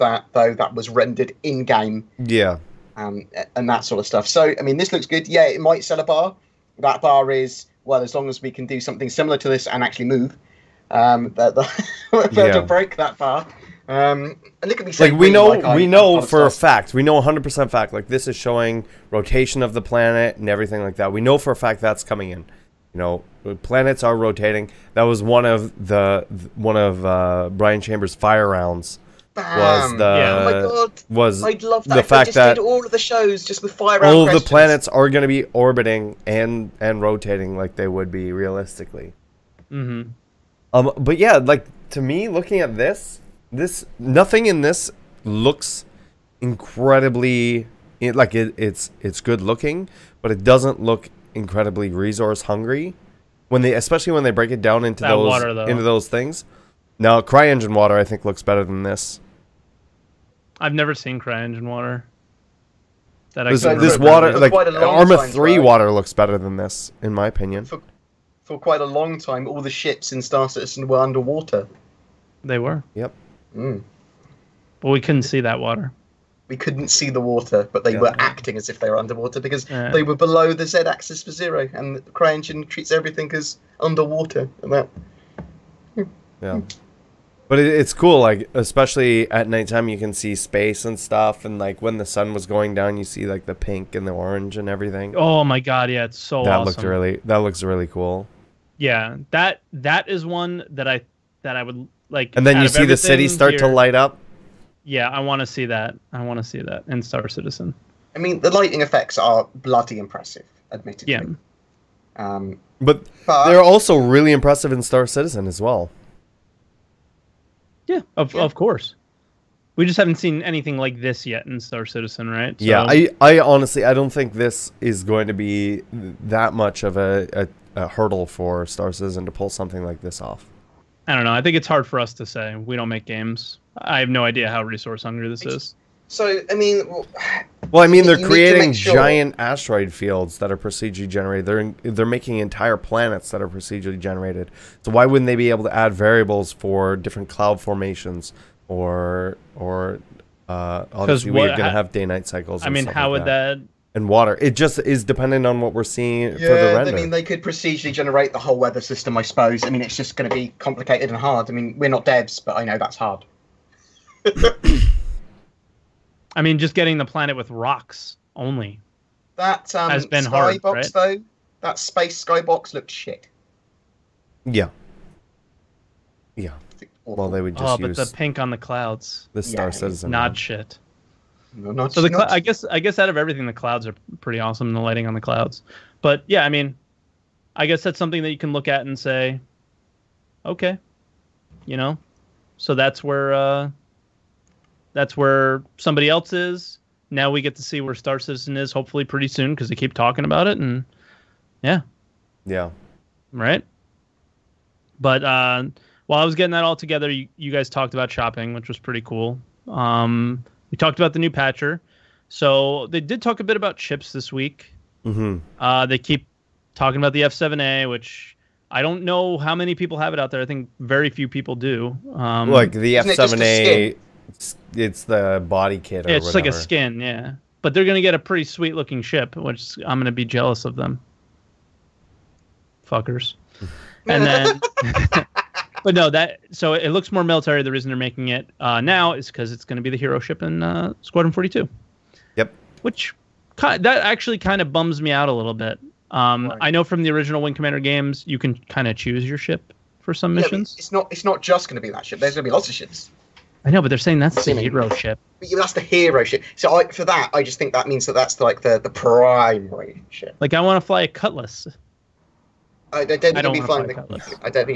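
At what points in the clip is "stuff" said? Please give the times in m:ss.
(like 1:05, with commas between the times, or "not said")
0:04, 1:30.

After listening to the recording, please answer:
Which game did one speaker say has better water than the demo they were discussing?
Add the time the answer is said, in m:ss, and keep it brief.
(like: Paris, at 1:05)
Arma 3, at 1:04.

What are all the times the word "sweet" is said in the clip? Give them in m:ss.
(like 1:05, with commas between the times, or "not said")
3:48.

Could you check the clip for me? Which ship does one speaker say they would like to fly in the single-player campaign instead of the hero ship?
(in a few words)
Cutlass.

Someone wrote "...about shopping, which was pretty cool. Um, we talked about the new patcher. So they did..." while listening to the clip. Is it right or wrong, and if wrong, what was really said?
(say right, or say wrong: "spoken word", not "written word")
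right.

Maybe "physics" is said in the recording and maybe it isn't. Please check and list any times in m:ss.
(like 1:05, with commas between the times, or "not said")
not said.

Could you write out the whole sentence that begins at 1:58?
of course we just haven't seen anything like this yet in Star Citizen, right?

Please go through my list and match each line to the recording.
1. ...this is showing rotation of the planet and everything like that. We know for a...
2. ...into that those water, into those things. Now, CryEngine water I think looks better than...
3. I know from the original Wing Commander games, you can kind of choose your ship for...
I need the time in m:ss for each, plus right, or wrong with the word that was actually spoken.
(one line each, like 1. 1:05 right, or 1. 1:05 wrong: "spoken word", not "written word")
1. 0:18 right
2. 0:54 right
3. 4:06 right.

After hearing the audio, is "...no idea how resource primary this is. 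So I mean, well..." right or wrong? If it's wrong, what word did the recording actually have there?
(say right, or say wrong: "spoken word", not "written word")
wrong: "hungry", not "primary".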